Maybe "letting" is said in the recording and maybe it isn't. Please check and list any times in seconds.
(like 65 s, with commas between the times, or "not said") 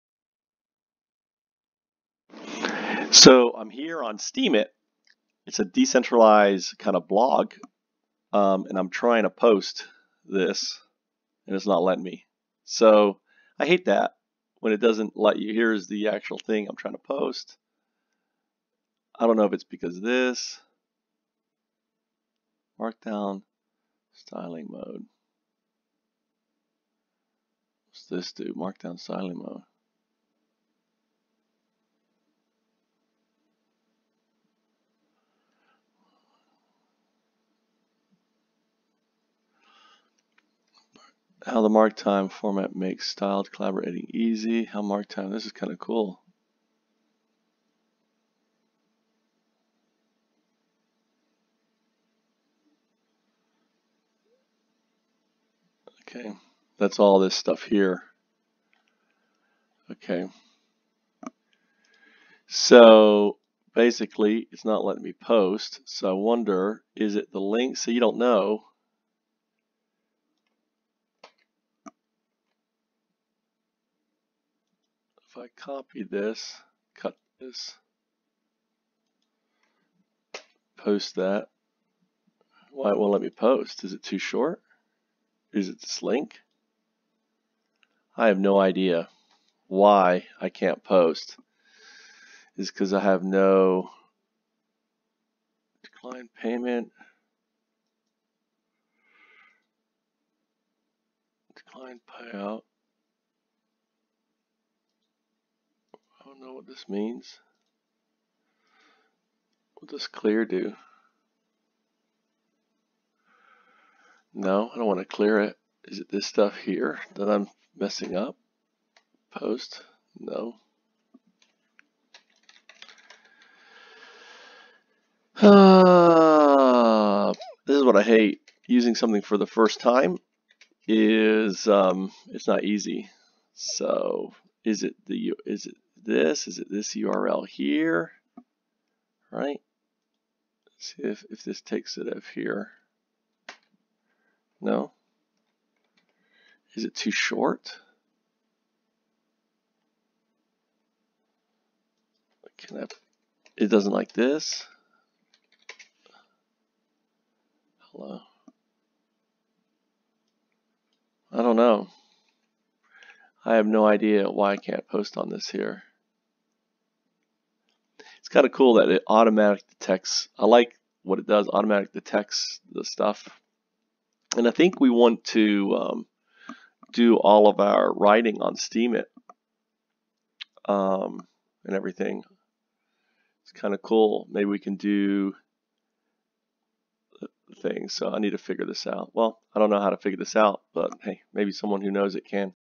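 11 s, 64 s.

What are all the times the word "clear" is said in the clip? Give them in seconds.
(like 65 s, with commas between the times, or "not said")
110 s, 115 s.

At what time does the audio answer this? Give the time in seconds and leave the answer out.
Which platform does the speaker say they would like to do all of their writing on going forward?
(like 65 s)
178 s.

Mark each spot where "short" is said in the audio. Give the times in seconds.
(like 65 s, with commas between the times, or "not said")
84 s, 147 s.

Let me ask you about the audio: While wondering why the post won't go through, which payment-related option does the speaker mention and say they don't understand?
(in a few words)
Decline payout.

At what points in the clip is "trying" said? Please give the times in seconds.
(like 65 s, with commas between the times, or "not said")
8 s, 16 s.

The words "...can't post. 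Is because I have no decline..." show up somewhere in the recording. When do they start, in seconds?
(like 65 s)
90 s.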